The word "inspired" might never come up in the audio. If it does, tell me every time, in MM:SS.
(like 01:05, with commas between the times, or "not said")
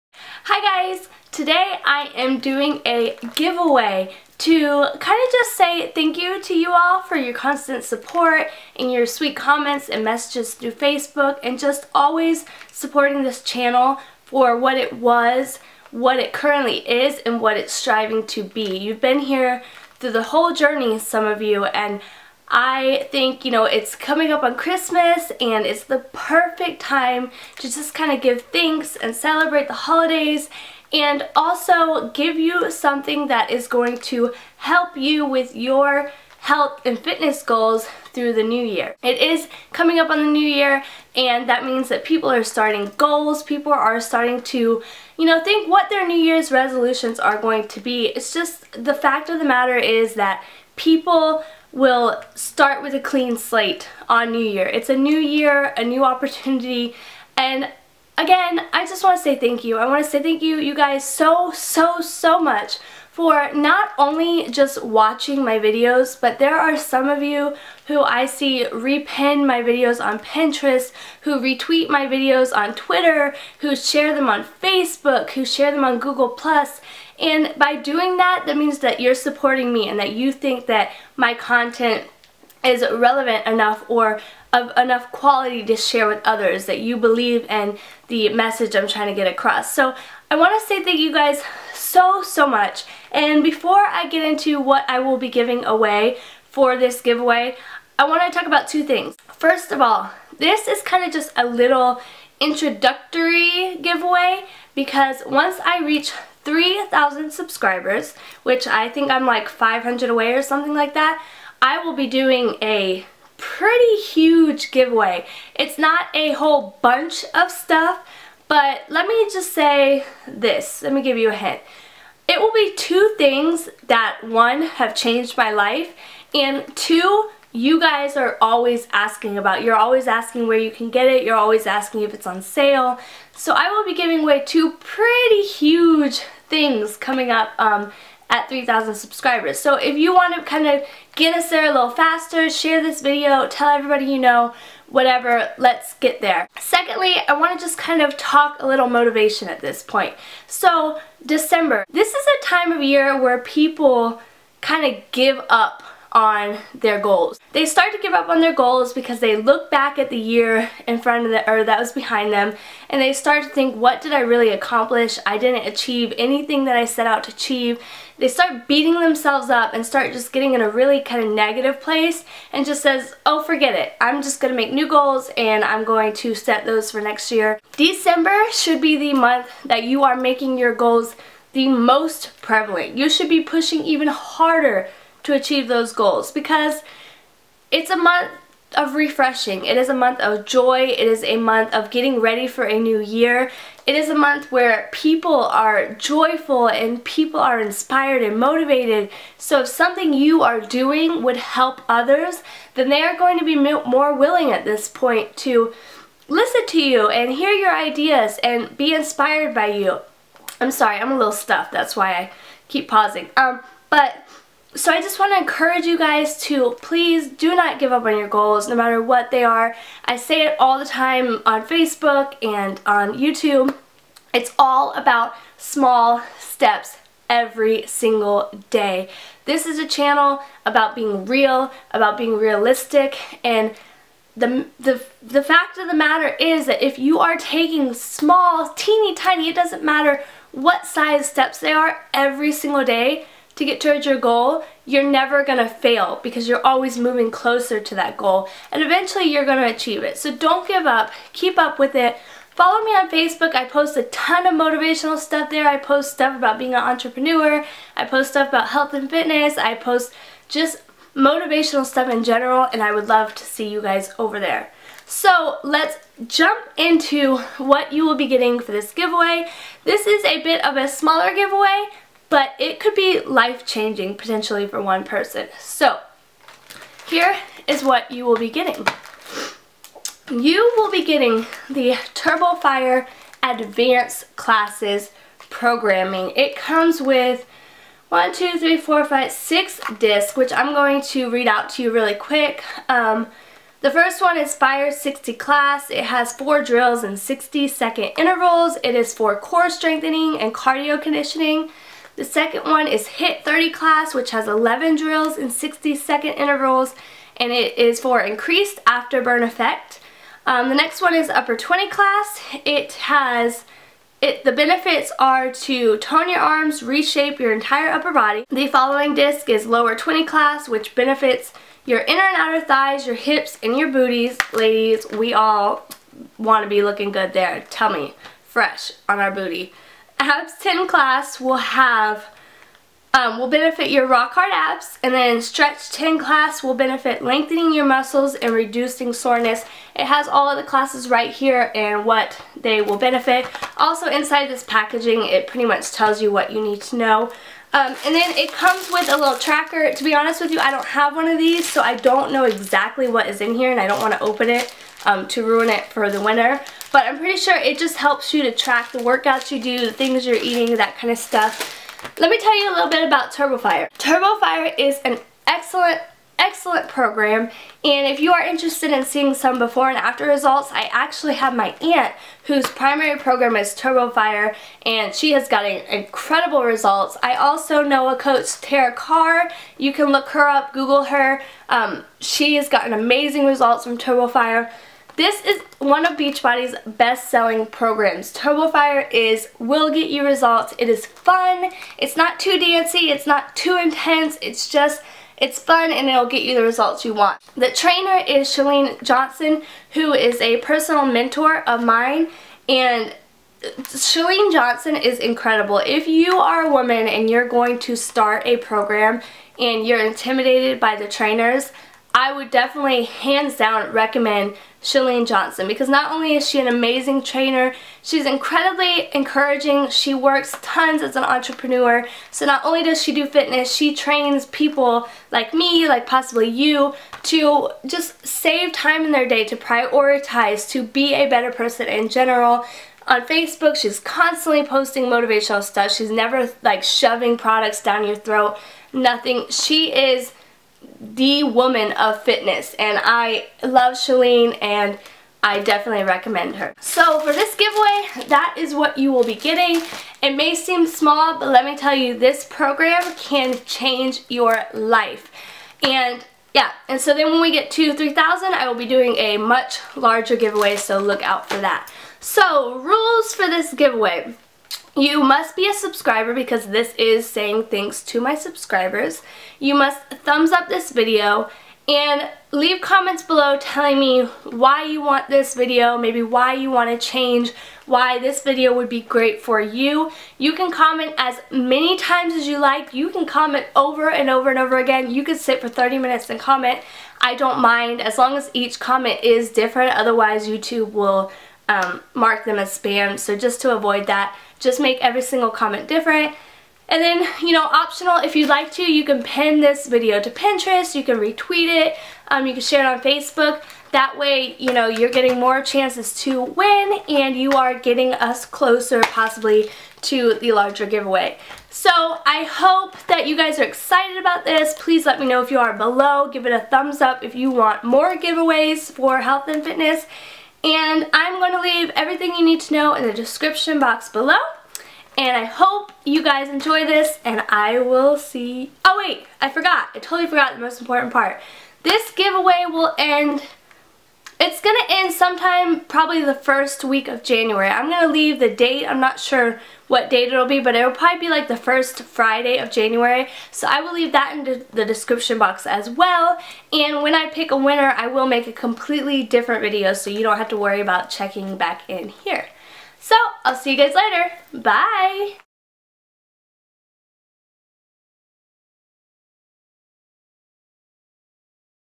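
03:17, 03:28.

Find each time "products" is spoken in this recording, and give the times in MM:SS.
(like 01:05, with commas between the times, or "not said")
07:17.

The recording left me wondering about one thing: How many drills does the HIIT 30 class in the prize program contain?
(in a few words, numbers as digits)
11.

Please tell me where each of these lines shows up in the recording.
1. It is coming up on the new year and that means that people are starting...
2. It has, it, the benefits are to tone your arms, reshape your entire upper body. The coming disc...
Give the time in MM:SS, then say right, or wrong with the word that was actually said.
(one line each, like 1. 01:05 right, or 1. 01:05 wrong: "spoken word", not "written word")
1. 00:39 right
2. 05:12 wrong: "following", not "coming".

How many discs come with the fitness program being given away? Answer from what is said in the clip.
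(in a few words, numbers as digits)
6.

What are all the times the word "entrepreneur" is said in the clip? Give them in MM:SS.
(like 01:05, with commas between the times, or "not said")
04:16, 07:01.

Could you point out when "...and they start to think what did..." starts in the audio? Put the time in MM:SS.
02:42.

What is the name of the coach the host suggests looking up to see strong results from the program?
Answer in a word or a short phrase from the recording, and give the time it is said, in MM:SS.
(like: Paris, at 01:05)
Tara Carr, at 06:18.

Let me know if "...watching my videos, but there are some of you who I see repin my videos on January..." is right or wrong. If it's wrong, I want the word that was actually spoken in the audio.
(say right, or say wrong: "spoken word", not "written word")
wrong: "Pinterest", not "January".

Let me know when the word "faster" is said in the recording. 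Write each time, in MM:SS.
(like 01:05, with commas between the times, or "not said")
02:21.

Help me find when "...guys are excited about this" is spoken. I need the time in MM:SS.
08:33.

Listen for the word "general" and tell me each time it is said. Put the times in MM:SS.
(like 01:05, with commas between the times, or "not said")
04:22, 07:12.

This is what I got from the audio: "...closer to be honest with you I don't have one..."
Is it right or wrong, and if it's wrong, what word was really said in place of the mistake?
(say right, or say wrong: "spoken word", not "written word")
wrong: "tracker", not "closer".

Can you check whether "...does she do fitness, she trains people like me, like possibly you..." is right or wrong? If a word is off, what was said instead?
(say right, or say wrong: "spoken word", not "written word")
right.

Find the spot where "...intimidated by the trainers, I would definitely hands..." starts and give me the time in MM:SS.
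06:50.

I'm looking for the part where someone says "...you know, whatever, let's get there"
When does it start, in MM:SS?
02:24.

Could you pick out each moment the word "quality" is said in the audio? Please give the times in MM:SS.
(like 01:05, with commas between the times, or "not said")
01:25.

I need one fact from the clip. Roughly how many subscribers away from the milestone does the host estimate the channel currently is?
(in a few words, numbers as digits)
500.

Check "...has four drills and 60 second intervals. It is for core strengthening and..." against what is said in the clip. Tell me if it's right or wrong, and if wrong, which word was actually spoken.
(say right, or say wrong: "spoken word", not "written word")
right.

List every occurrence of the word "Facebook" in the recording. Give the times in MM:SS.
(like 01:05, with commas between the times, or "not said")
00:10, 01:14, 03:41, 04:13, 07:13, 08:22.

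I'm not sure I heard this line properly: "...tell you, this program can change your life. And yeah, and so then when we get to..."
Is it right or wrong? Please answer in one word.
right.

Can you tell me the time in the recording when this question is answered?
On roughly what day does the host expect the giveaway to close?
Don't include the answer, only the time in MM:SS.
09:01.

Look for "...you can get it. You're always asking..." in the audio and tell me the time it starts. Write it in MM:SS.
02:10.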